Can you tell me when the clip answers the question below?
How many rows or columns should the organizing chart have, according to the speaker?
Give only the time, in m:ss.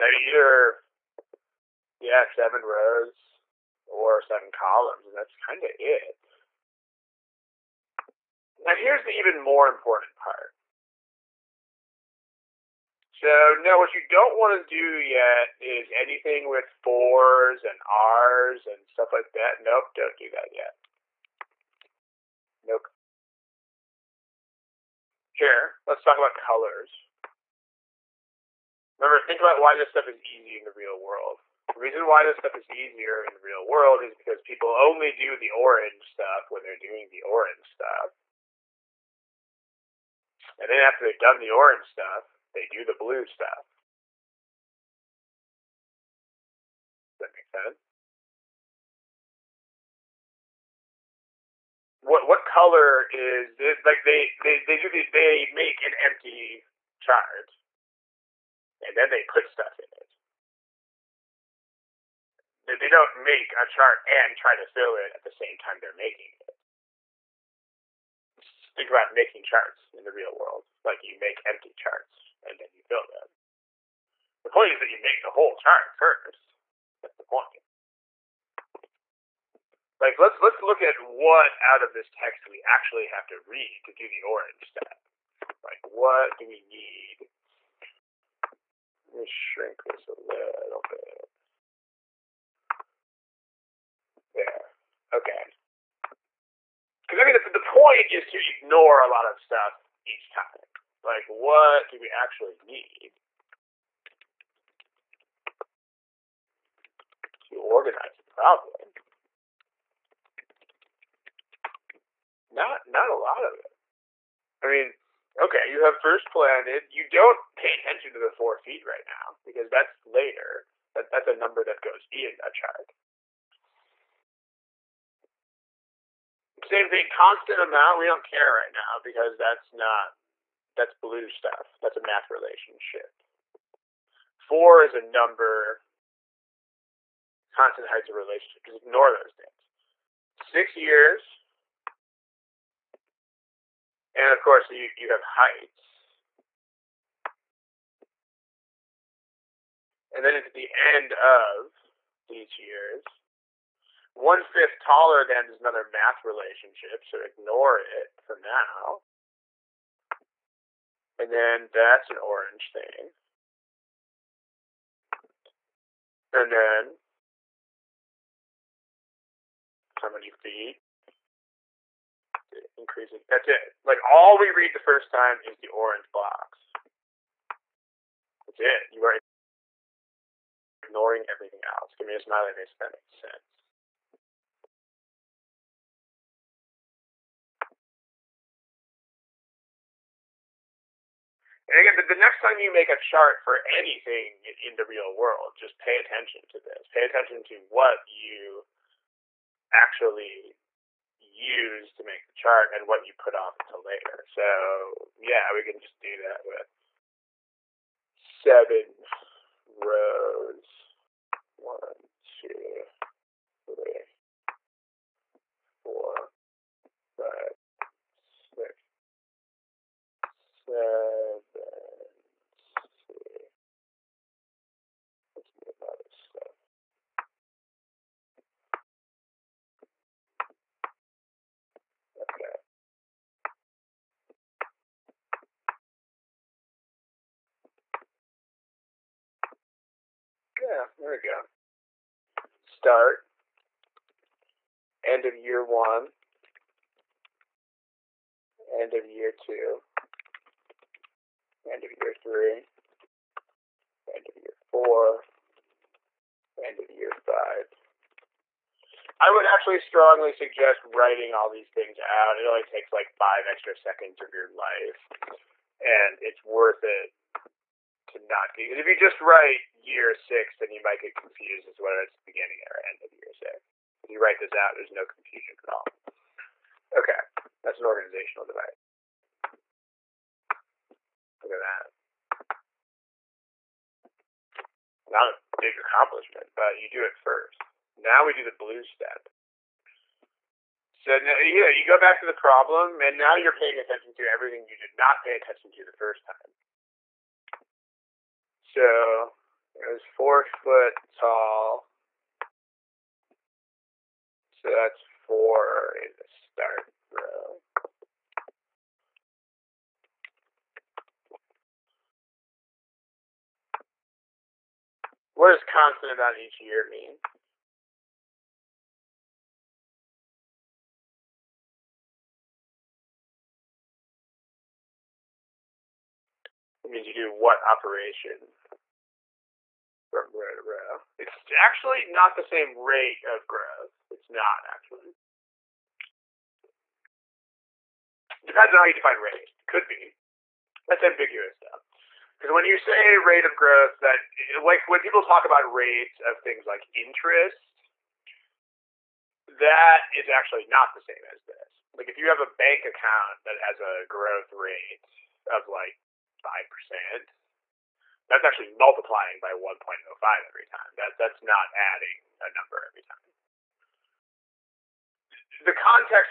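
0:02.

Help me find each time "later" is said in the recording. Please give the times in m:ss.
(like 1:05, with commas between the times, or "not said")
2:00, 3:23.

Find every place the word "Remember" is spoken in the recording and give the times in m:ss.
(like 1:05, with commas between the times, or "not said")
0:28.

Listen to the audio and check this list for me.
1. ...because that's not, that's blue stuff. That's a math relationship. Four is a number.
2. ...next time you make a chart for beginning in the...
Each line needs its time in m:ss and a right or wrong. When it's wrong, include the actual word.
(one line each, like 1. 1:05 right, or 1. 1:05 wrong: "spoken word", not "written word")
1. 2:09 right
2. 3:12 wrong: "anything", not "beginning".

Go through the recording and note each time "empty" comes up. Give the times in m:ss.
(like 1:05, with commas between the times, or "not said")
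0:56, 1:11.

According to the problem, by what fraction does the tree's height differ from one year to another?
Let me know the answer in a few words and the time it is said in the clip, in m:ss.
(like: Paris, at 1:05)
one fifth, at 2:34.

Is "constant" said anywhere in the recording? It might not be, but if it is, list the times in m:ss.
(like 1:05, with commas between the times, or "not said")
2:07, 2:17, 5:15.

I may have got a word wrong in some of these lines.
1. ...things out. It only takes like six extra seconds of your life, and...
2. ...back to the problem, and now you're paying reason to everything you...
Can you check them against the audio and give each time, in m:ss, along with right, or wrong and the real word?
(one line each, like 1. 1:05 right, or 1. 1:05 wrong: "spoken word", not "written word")
1. 4:21 wrong: "five", not "six"
2. 4:51 wrong: "attention", not "reason".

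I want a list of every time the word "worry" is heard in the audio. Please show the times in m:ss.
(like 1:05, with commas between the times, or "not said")
not said.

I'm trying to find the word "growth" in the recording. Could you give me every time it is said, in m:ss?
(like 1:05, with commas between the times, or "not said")
5:33, 5:43, 5:54.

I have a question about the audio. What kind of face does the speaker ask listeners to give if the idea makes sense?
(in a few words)
smiley face.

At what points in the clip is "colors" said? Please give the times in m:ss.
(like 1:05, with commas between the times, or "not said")
0:26, 0:52.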